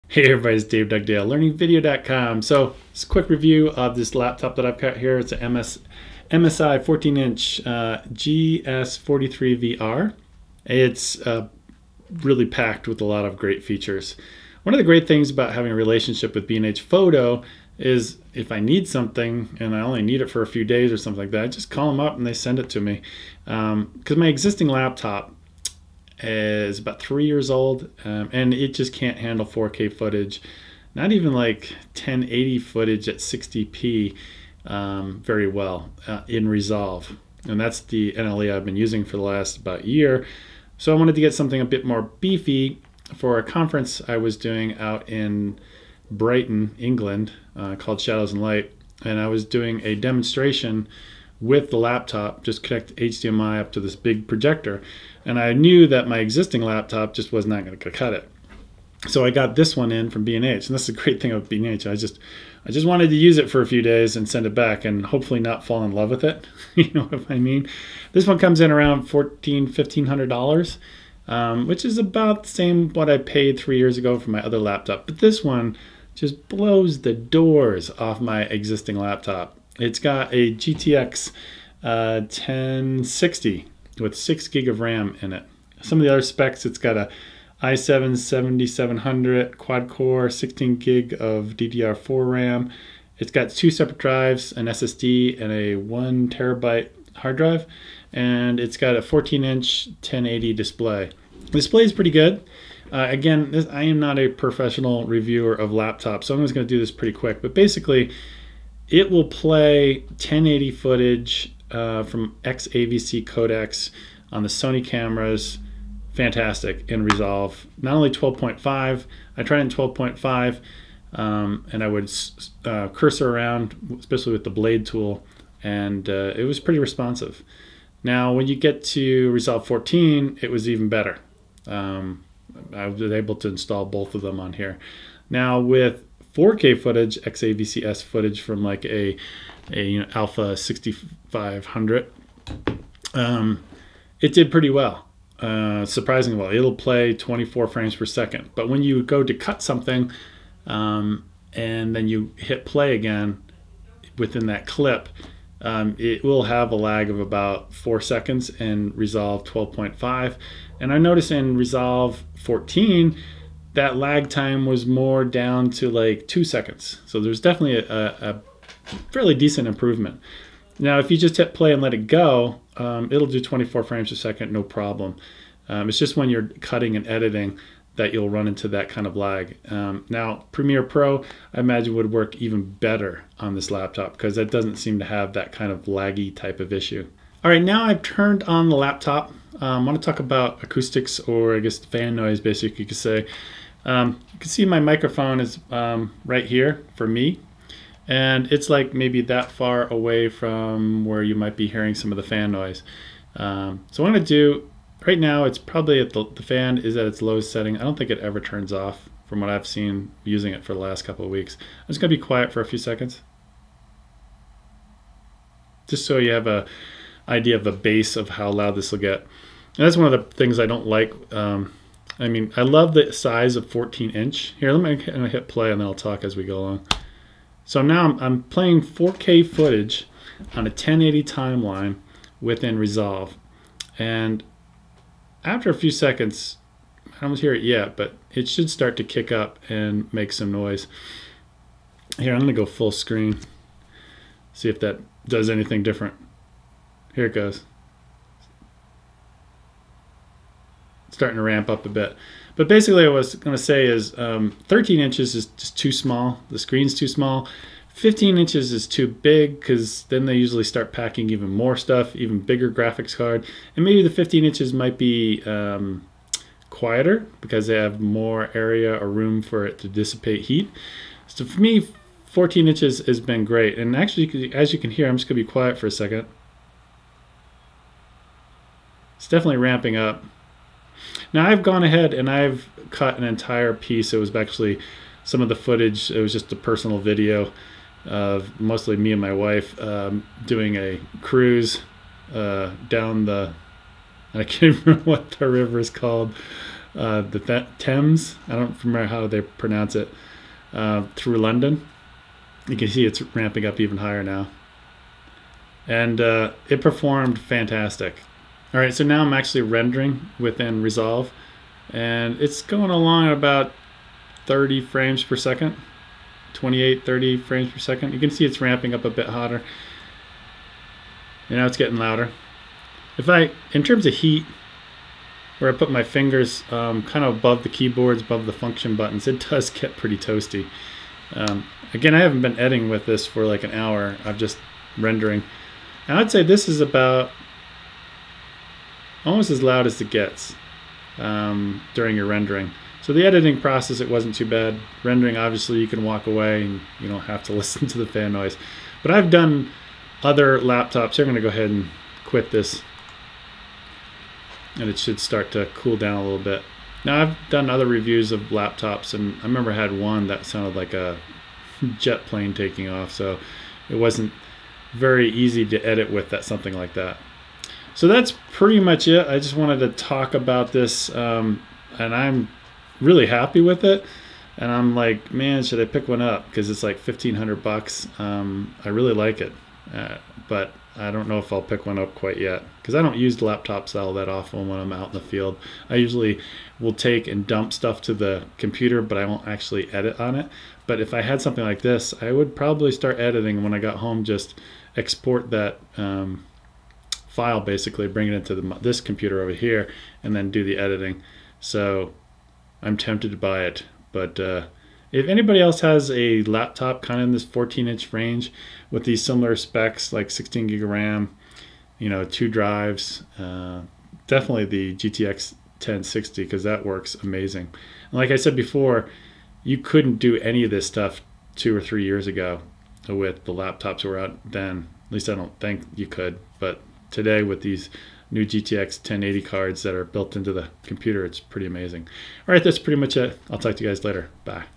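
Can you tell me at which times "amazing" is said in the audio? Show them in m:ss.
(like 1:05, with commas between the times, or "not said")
6:57, 7:11.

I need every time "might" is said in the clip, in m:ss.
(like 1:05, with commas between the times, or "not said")
3:21, 4:24.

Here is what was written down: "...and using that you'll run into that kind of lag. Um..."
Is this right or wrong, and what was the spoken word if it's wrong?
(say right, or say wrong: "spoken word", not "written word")
wrong: "editing", not "using".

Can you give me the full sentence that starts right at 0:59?
So I got this one in from B&H, and that's the great thing about B&H.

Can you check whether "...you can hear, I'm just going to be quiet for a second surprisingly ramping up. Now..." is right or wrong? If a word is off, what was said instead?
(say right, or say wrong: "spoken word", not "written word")
wrong: "definitely", not "surprisingly".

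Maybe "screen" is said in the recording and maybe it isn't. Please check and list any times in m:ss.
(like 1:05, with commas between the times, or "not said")
4:02, 4:16.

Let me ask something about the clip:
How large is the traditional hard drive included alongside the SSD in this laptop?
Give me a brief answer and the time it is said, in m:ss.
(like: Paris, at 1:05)
1 terabyte, at 1:35.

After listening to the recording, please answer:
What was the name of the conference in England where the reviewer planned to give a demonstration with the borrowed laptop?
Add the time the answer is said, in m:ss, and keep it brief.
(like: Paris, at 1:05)
Shadows and Light, at 0:47.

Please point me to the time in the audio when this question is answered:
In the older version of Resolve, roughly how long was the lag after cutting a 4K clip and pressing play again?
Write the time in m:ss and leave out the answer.
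2:37.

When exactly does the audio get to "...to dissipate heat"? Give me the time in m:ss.
4:29.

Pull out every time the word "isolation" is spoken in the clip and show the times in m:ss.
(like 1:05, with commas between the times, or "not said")
not said.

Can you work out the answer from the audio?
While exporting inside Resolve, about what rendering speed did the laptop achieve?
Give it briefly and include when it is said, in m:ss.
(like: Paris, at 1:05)
28-30 frames per second, at 5:16.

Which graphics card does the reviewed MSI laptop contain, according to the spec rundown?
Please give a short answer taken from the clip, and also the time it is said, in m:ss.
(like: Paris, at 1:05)
GTX 1060, at 1:20.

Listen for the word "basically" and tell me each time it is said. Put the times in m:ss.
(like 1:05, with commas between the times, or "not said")
1:47, 3:12, 4:12, 6:37.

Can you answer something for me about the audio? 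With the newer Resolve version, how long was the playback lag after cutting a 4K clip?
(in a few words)
2 seconds.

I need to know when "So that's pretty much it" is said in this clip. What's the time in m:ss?
6:07.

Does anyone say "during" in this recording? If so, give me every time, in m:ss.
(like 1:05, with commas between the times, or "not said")
5:41.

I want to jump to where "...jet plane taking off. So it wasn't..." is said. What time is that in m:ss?
6:01.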